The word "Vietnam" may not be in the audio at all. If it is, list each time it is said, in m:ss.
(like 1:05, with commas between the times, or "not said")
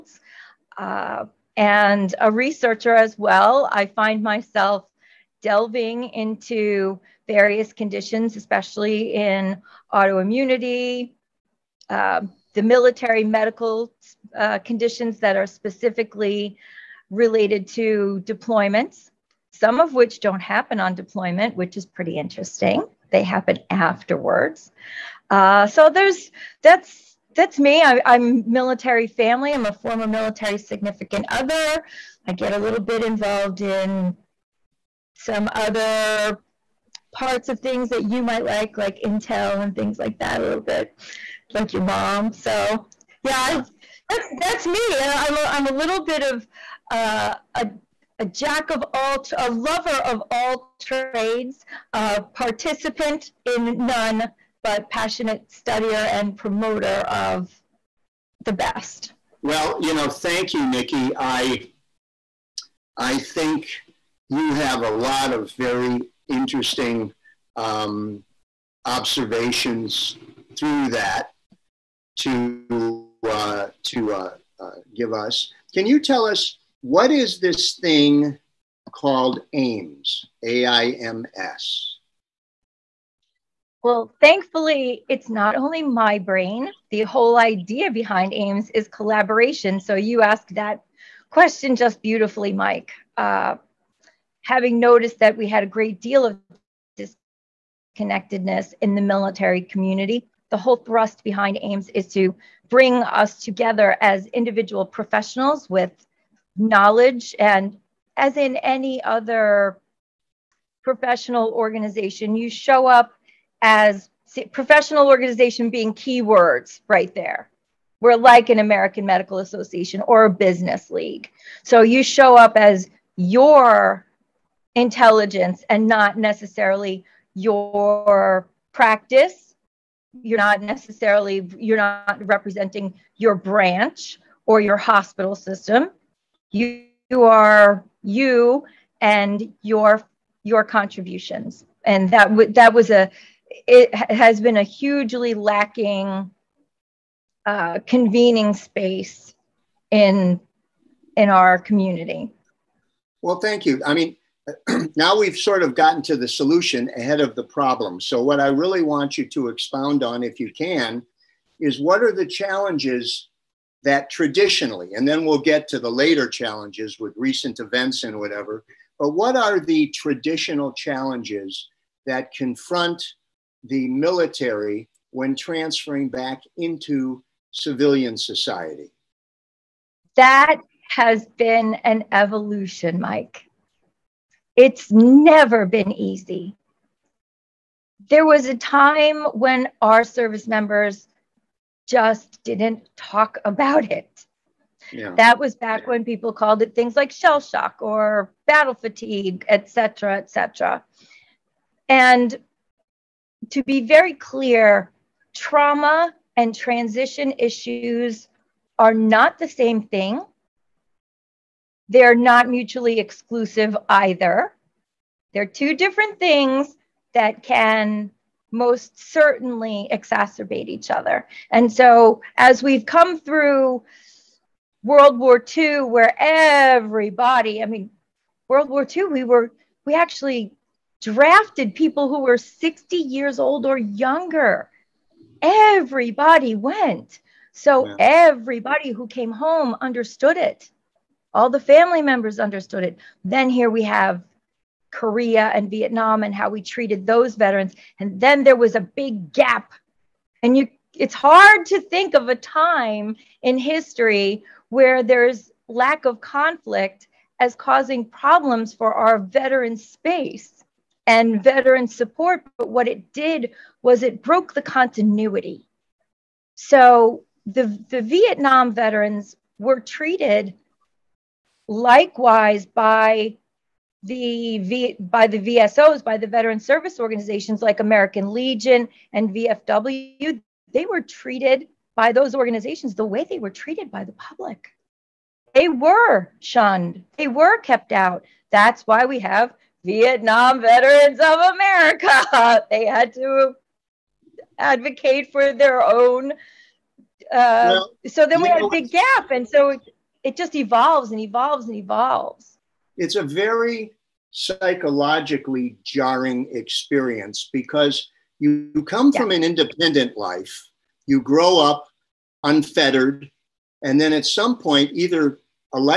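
4:05, 4:28, 4:49.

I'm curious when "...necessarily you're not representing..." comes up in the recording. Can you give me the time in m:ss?
2:10.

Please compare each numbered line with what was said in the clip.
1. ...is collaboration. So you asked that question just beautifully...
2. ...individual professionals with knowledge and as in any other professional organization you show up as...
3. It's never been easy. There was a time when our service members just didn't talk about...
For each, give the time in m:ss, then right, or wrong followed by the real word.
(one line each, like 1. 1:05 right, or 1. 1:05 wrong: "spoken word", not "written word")
1. 1:28 right
2. 1:44 right
3. 3:04 right.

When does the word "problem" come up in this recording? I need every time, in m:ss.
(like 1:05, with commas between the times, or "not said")
2:37, 4:18.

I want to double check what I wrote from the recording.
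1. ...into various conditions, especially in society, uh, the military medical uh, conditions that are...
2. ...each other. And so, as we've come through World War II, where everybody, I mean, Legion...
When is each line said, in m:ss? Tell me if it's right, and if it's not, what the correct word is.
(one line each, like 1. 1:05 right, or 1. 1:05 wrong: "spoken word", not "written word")
1. 0:06 wrong: "autoimmunity", not "society"
2. 3:40 wrong: "World", not "Legion".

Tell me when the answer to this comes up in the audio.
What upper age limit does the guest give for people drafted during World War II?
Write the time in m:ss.
3:52.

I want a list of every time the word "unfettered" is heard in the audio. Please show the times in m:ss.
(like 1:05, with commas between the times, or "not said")
5:12.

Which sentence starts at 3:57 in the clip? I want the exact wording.
everybody who came home understood it.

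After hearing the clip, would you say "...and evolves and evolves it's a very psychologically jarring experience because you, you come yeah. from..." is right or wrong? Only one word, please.
right.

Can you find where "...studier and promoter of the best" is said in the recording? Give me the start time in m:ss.
0:55.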